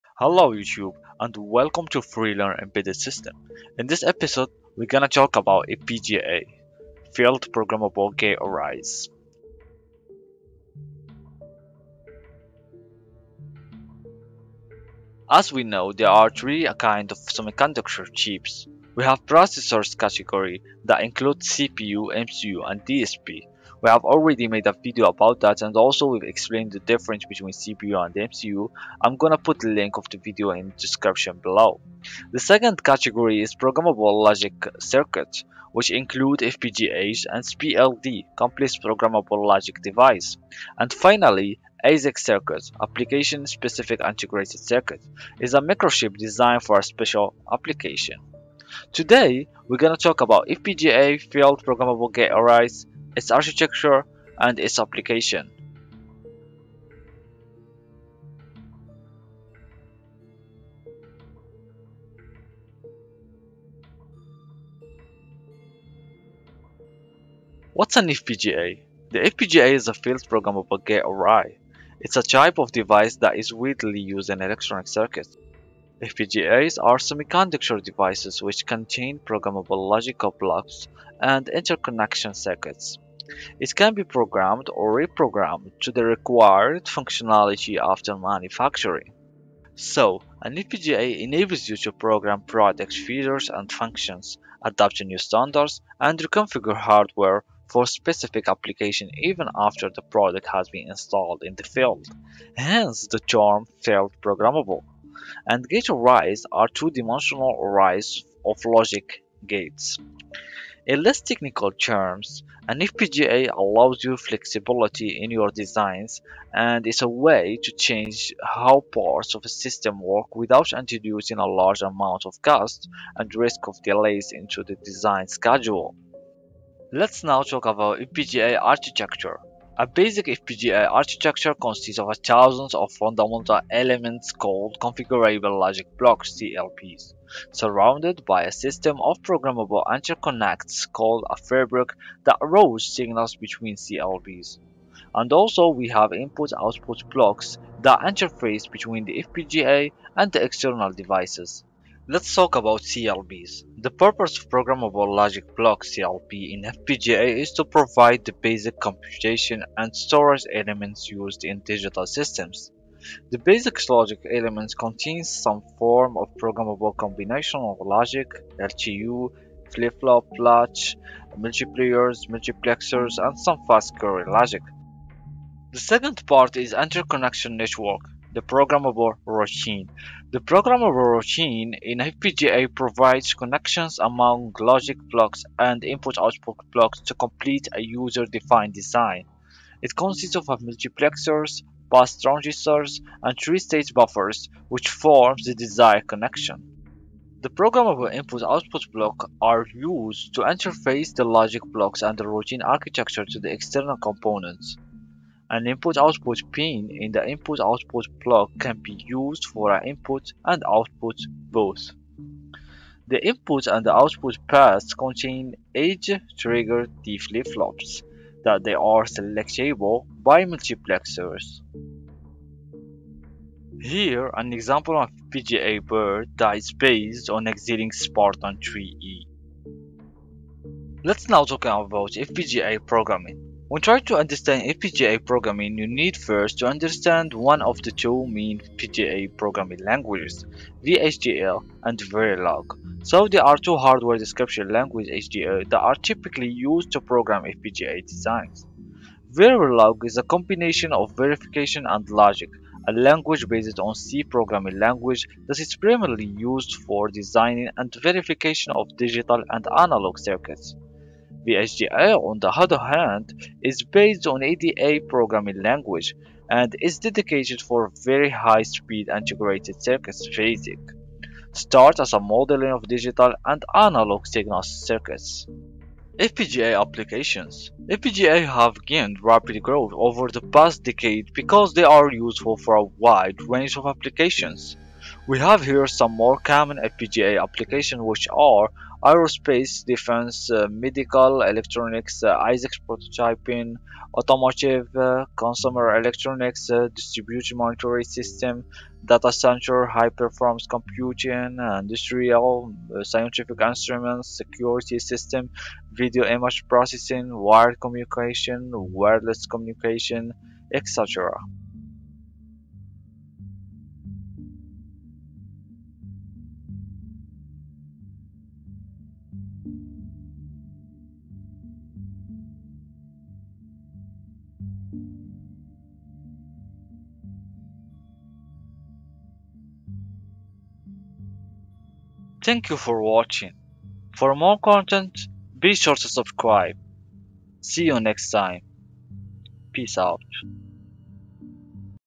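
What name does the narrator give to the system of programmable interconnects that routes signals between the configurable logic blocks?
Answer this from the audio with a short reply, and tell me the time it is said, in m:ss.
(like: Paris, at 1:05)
fabric, at 2:21.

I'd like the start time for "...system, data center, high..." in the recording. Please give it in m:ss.
4:58.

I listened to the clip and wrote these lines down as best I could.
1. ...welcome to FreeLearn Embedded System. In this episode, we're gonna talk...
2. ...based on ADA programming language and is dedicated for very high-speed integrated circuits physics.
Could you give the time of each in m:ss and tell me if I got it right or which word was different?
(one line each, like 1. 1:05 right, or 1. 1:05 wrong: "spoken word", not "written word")
1. 0:01 right
2. 4:23 right.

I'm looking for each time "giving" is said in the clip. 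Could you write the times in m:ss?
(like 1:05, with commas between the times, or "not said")
not said.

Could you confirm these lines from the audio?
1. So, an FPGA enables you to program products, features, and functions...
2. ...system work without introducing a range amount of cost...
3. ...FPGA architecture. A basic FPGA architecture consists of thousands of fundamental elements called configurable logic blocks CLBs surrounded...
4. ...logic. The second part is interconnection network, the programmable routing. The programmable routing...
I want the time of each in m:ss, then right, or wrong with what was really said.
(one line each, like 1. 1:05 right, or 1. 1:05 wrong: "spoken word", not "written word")
1. 1:29 right
2. 1:59 wrong: "large", not "range"
3. 2:07 right
4. 2:54 right.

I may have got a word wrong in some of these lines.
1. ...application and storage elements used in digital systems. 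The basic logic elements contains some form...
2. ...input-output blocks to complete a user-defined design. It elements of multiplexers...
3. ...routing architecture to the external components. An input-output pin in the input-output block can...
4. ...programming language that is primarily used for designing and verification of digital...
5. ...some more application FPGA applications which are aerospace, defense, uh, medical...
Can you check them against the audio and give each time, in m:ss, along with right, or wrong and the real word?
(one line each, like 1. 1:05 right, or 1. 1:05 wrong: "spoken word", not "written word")
1. 2:38 wrong: "computation", not "application"
2. 3:05 wrong: "consists", not "elements"
3. 3:22 right
4. 4:14 right
5. 4:45 wrong: "common", not "application".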